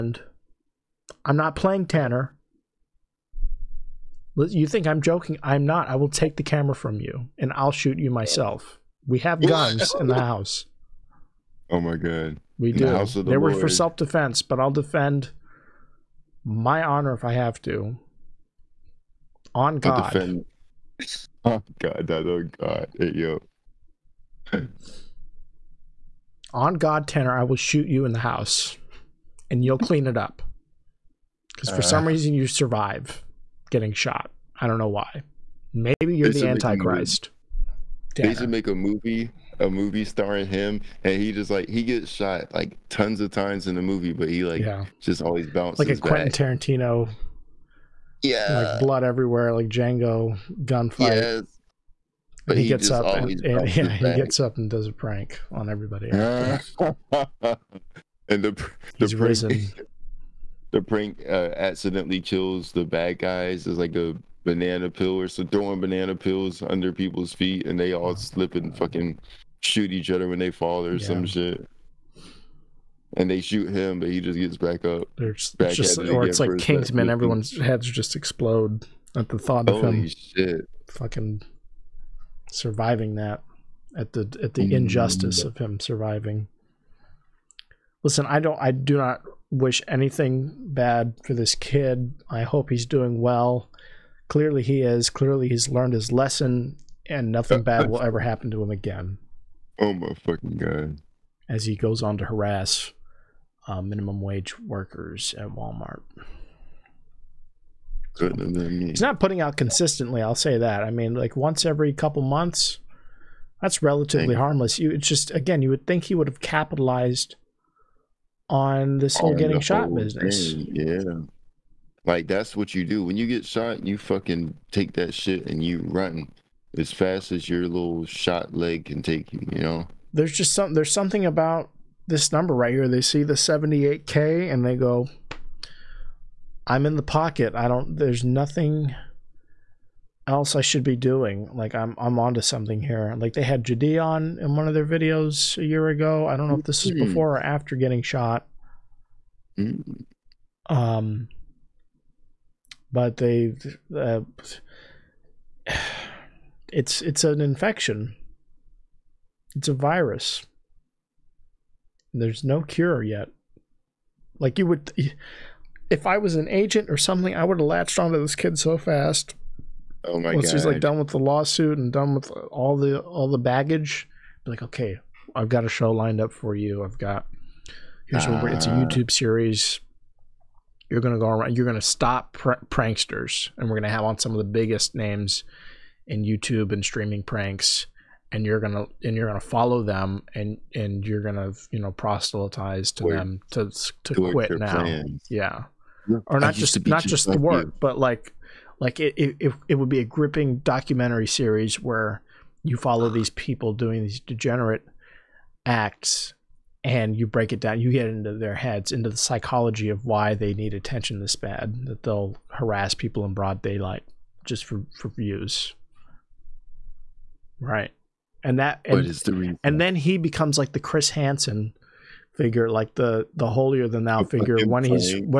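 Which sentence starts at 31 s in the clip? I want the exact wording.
Because for uh, some reason you survive getting shot.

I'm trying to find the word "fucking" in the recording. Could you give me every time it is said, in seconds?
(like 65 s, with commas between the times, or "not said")
68 s, 80 s, 100 s, 123 s.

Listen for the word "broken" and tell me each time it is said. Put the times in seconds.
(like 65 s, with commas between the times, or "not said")
not said.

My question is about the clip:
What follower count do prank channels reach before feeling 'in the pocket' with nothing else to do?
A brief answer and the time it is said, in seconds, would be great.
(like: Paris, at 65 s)
78K, at 133 s.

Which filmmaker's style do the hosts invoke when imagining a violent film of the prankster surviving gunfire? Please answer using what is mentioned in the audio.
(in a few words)
Quentin Tarantino.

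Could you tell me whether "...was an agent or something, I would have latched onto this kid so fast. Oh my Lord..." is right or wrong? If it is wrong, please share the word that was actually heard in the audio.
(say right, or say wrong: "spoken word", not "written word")
wrong: "Once", not "Lord".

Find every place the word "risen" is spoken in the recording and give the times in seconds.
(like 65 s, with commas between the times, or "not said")
59 s.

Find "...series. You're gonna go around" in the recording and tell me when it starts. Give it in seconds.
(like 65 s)
179 s.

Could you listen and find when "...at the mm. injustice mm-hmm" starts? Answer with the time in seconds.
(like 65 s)
84 s.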